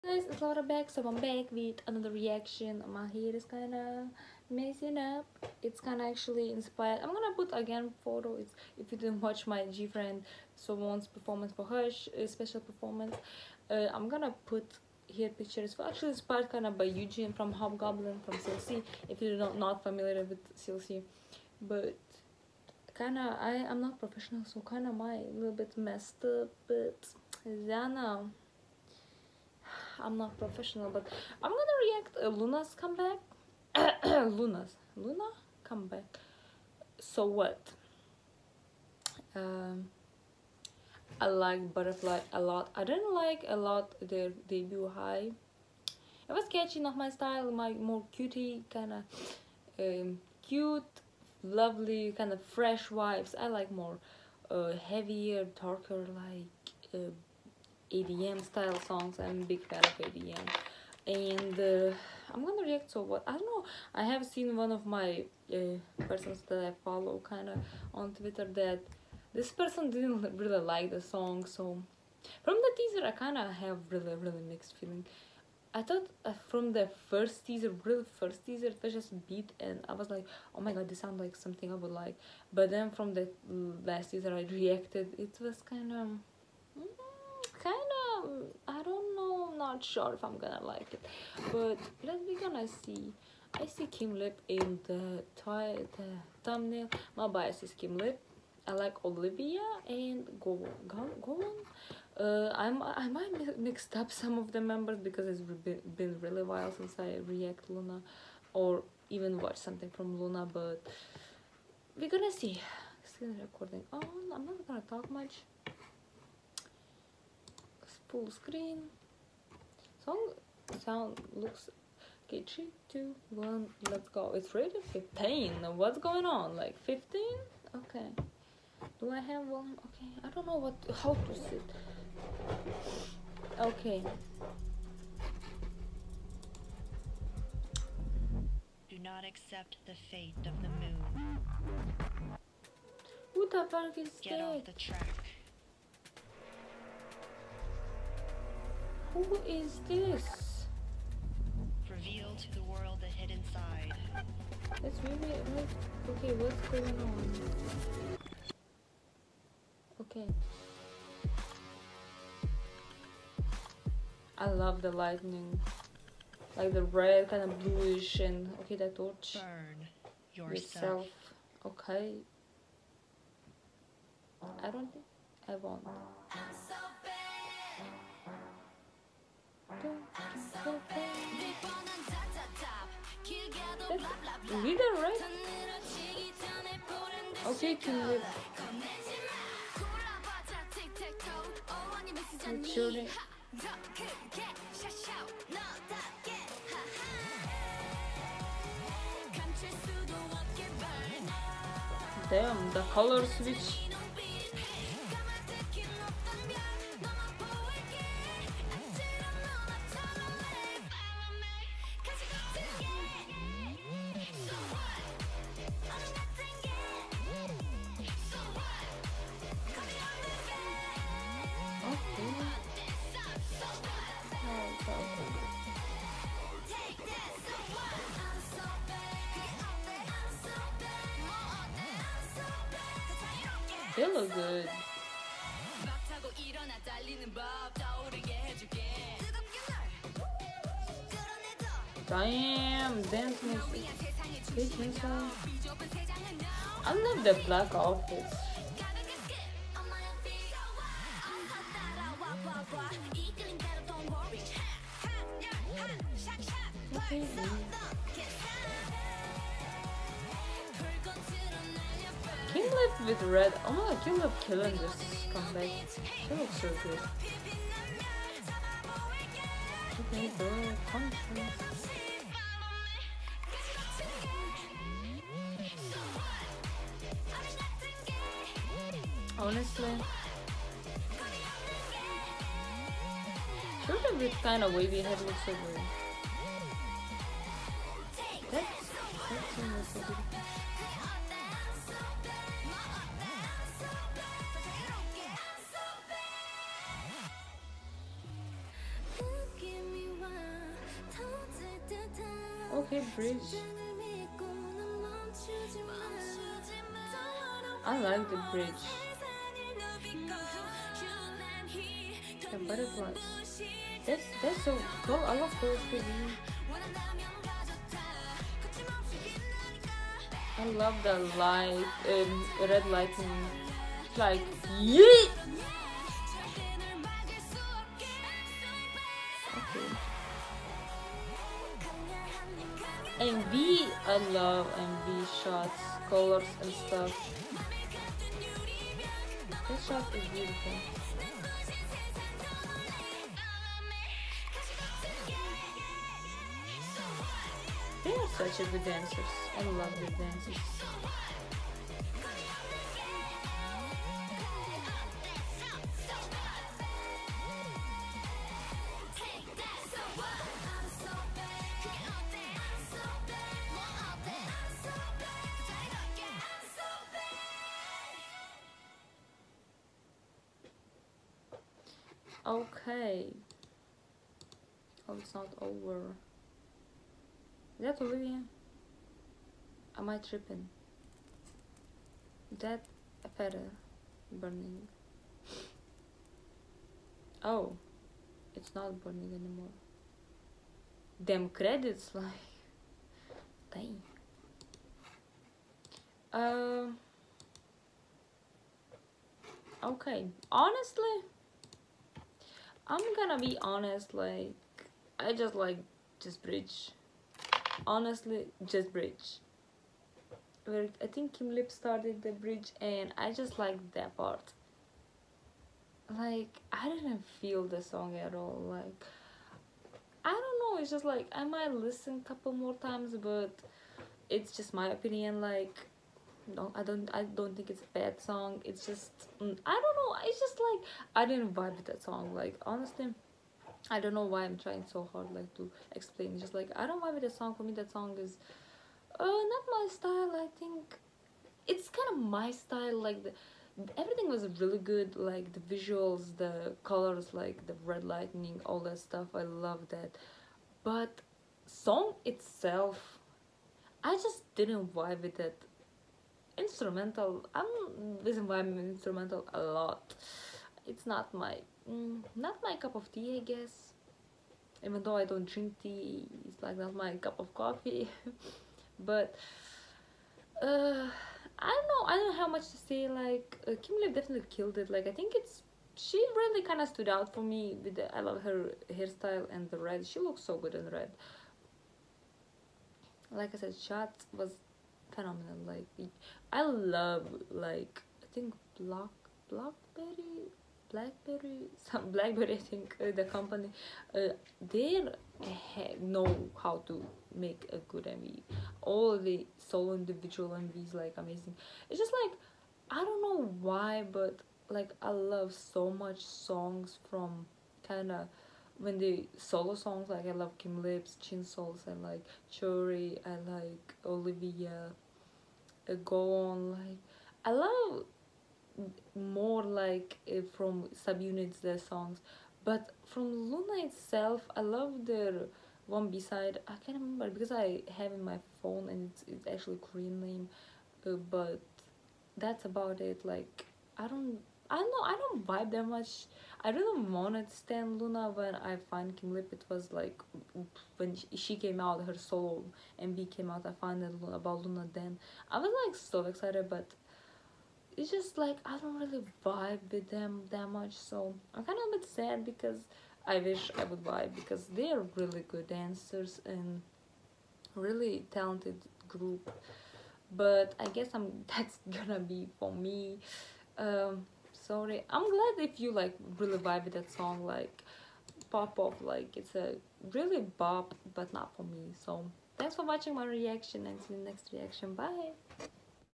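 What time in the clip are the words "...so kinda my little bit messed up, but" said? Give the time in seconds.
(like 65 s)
24 s.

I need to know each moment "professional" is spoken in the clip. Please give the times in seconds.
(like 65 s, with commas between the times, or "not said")
23 s, 30 s.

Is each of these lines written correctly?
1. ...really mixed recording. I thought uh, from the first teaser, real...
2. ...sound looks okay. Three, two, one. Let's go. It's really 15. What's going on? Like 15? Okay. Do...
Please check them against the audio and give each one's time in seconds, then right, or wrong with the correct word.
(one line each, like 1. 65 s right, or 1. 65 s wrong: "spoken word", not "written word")
1. 74 s wrong: "feeling", not "recording"
2. 120 s right.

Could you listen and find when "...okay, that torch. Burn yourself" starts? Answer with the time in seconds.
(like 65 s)
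168 s.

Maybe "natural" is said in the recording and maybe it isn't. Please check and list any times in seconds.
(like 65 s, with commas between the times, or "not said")
not said.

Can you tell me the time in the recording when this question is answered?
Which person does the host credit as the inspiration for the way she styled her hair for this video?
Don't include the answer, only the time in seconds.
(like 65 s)
16 s.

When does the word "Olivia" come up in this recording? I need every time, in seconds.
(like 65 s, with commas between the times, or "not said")
99 s, 378 s, 514 s.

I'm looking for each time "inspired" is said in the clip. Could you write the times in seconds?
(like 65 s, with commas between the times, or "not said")
6 s, 16 s.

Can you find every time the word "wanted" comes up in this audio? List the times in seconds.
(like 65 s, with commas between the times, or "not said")
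537 s.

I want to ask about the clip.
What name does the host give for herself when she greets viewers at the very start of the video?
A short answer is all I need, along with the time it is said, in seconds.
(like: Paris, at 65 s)
Laura, at 0 s.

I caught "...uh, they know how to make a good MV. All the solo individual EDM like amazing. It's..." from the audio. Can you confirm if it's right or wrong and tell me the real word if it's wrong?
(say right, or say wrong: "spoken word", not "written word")
wrong: "MVs", not "EDM".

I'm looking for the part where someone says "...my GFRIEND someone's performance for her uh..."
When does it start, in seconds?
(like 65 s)
9 s.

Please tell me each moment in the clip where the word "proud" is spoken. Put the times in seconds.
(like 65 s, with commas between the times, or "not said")
not said.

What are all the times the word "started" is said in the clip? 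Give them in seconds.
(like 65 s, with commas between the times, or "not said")
411 s.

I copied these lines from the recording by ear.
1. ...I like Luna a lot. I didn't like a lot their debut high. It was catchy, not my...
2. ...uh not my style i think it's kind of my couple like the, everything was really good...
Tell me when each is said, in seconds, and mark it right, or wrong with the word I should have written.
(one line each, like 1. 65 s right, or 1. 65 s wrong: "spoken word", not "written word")
1. 41 s wrong: "Butterfly", not "Luna"
2. 439 s wrong: "style", not "couple".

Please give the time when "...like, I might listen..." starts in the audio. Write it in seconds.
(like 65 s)
421 s.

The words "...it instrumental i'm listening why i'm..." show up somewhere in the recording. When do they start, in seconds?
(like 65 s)
455 s.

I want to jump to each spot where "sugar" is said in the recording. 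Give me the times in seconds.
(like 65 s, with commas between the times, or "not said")
not said.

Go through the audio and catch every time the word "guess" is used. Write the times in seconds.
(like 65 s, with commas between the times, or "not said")
463 s, 560 s.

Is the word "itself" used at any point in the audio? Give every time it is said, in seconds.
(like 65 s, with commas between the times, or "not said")
452 s, 523 s.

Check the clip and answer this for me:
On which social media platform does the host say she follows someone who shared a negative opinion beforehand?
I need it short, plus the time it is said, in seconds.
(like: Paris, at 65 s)
Twitter, at 68 s.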